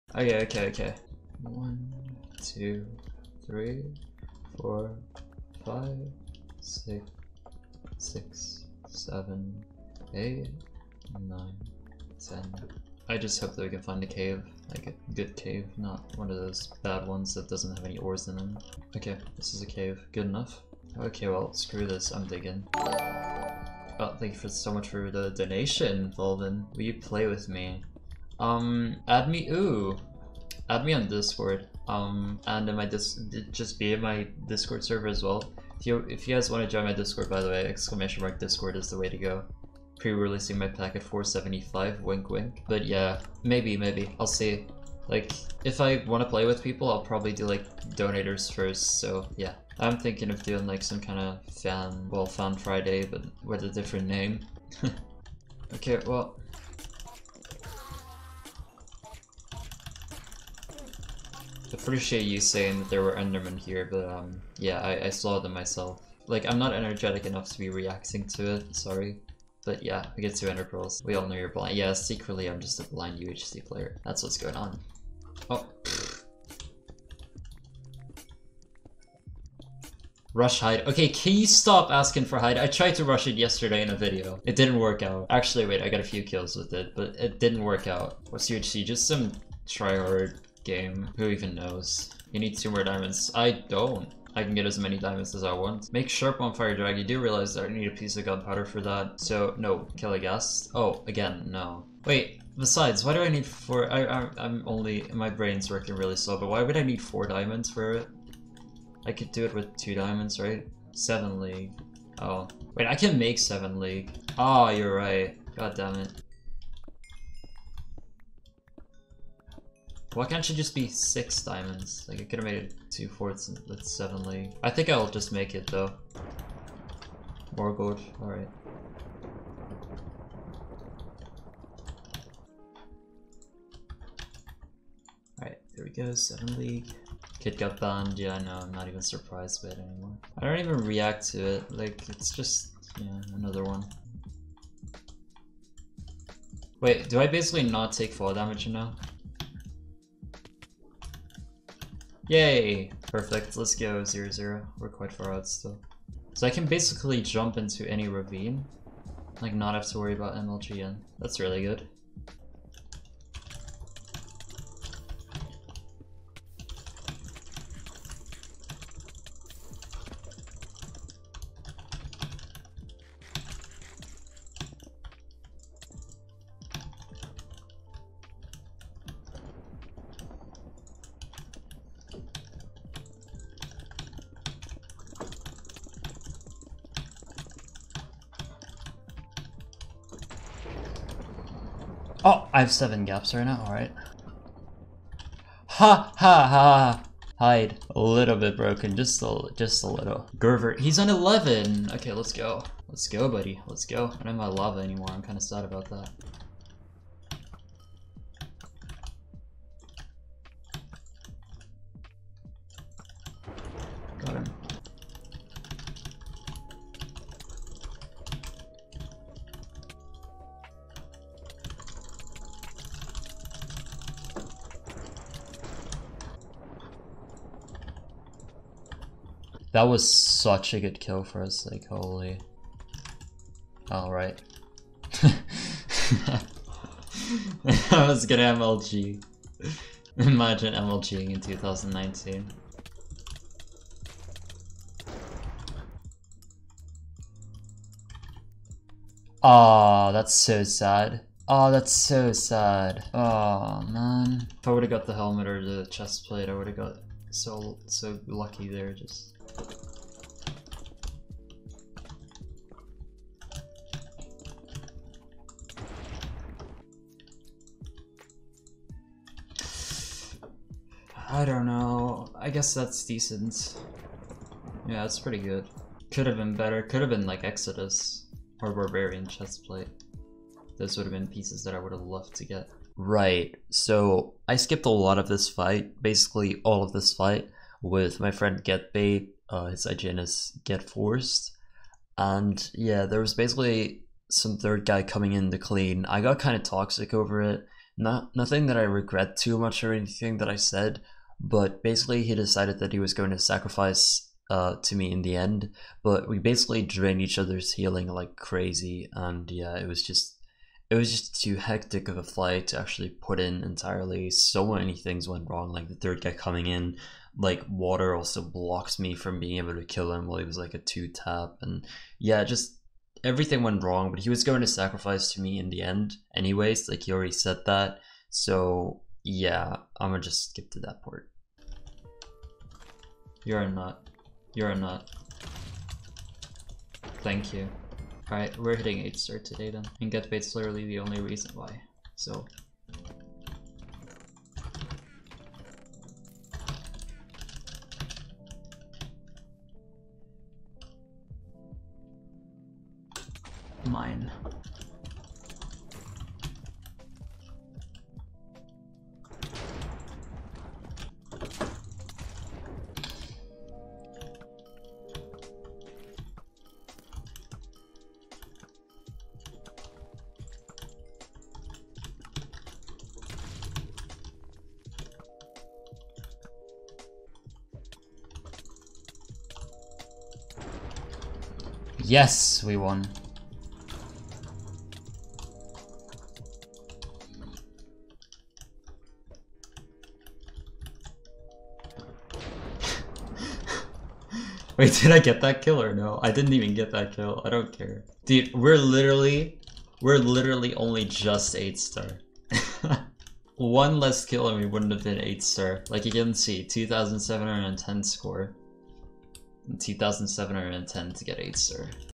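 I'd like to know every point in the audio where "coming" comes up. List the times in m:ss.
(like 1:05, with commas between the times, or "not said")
4:55, 5:16.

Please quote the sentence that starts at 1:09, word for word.
But yeah, we get two Ender Pearls.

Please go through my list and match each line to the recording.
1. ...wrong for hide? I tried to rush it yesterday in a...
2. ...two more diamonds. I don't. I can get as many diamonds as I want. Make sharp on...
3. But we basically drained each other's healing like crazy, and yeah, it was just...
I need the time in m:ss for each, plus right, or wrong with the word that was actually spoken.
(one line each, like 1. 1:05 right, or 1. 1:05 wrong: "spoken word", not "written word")
1. 1:21 wrong: "asking", not "wrong"
2. 1:32 right
3. 5:06 right.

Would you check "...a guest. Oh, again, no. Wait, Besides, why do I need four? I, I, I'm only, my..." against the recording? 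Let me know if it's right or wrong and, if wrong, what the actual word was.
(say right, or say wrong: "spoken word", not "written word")
right.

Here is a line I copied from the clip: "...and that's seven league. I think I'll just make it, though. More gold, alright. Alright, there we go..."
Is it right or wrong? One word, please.
right.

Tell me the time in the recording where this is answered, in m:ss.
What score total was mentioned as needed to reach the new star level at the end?
6:46.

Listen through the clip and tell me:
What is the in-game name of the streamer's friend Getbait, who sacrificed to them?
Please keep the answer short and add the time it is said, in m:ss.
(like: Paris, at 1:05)
Get Forced, at 4:50.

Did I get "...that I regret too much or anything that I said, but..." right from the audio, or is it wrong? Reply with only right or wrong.
right.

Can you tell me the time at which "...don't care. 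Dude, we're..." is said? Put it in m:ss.
6:37.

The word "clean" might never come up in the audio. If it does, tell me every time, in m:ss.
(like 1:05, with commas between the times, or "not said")
4:55.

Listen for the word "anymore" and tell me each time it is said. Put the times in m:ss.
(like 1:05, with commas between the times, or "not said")
2:19, 3:24.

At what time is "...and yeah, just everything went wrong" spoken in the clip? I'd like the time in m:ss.
5:21.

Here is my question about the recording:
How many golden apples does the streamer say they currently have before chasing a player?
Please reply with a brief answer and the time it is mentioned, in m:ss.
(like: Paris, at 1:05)
7, at 3:12.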